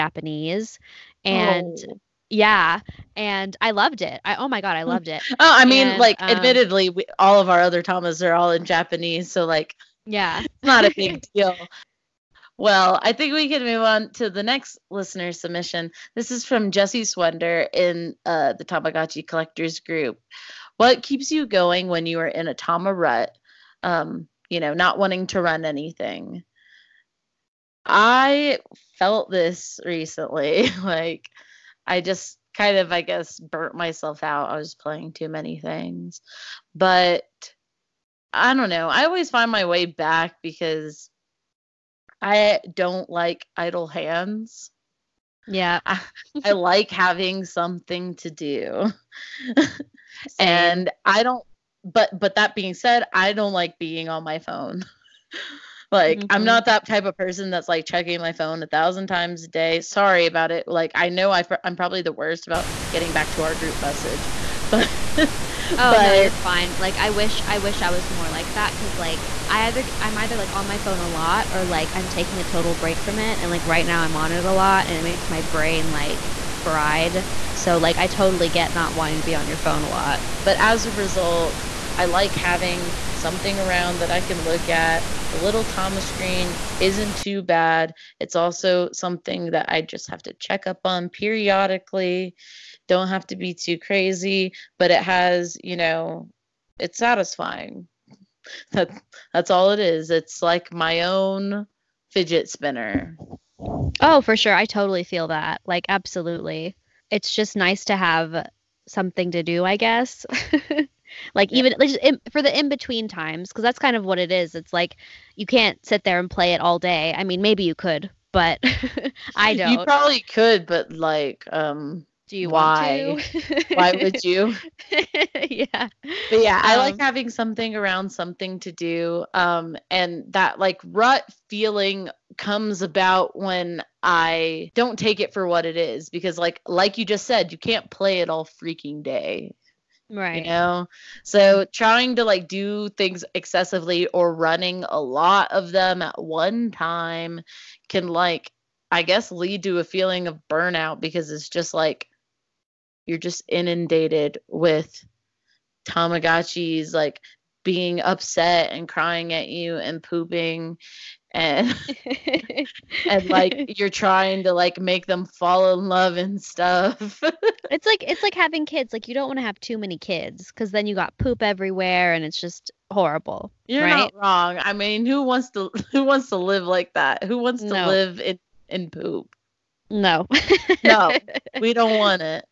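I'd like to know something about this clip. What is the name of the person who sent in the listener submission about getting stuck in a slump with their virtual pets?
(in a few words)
Jesse Swender.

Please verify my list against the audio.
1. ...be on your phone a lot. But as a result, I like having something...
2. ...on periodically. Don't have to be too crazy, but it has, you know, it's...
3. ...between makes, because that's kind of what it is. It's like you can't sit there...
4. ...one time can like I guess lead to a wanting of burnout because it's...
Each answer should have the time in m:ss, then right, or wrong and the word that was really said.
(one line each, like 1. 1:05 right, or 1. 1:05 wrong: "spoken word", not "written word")
1. 1:19 right
2. 1:30 right
3. 1:52 wrong: "times", not "makes"
4. 2:26 wrong: "feeling", not "wanting".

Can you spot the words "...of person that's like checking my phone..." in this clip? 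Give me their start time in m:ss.
0:57.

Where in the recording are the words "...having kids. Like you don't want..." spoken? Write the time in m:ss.
2:48.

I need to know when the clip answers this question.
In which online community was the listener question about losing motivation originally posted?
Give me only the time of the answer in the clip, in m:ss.
0:18.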